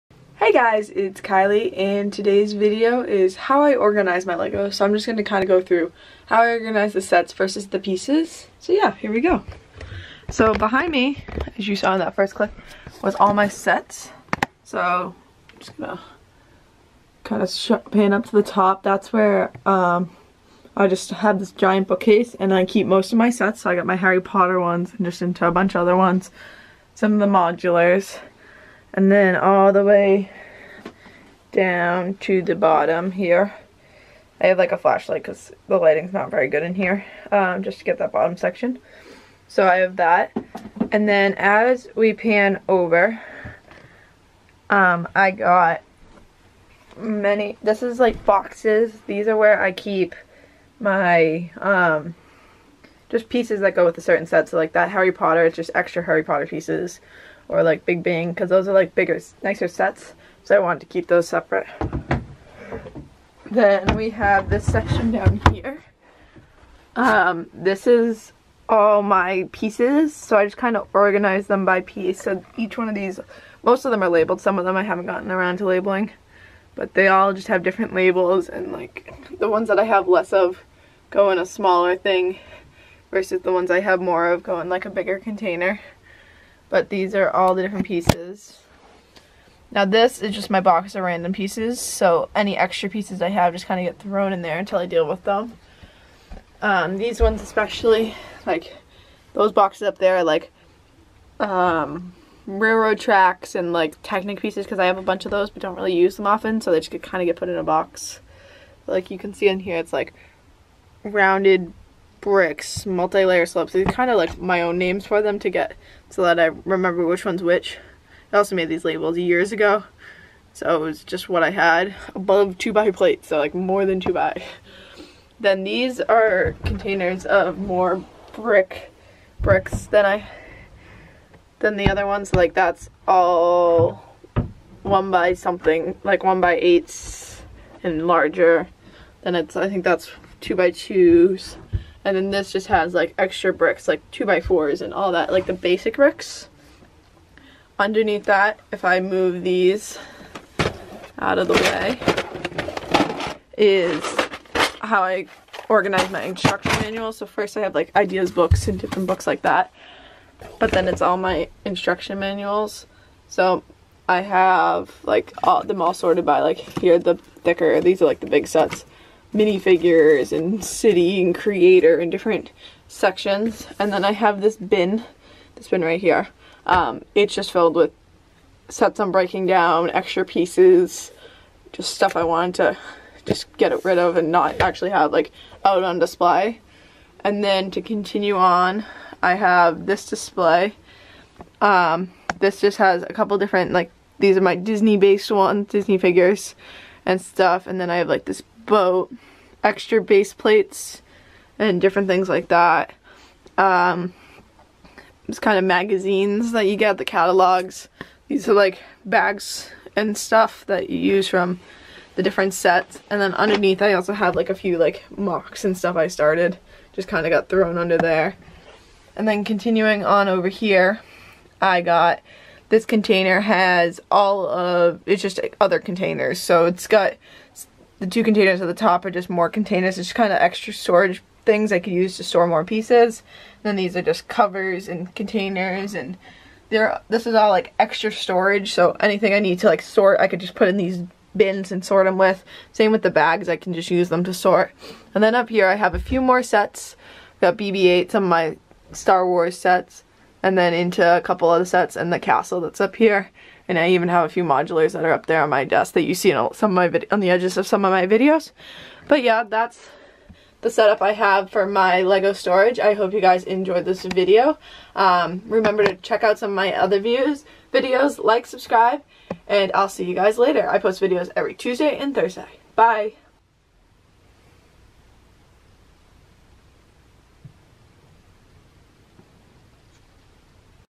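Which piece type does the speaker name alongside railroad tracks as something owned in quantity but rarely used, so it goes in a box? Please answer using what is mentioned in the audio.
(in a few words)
Technic pieces.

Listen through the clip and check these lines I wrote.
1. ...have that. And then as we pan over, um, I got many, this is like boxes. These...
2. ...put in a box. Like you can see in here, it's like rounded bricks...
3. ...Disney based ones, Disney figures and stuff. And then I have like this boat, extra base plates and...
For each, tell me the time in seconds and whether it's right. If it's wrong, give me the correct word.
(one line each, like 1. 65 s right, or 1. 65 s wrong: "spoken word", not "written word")
1. 39 s right
2. 107 s right
3. 194 s right.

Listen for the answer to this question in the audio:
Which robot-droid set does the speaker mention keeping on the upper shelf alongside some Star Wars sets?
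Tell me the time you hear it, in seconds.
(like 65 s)
247 s.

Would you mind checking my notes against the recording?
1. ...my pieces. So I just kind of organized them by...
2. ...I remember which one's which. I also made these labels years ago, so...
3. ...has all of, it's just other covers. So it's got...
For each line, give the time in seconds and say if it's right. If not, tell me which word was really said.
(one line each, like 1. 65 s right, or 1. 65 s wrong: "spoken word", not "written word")
1. 69 s right
2. 116 s right
3. 223 s wrong: "containers", not "covers".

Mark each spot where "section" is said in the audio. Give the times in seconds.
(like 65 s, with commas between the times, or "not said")
38 s, 64 s, 172 s.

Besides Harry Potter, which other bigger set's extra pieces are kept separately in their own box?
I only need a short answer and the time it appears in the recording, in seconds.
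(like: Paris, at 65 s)
Big Bang, at 57 s.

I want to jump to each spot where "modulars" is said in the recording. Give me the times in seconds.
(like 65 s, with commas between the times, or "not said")
27 s, 254 s.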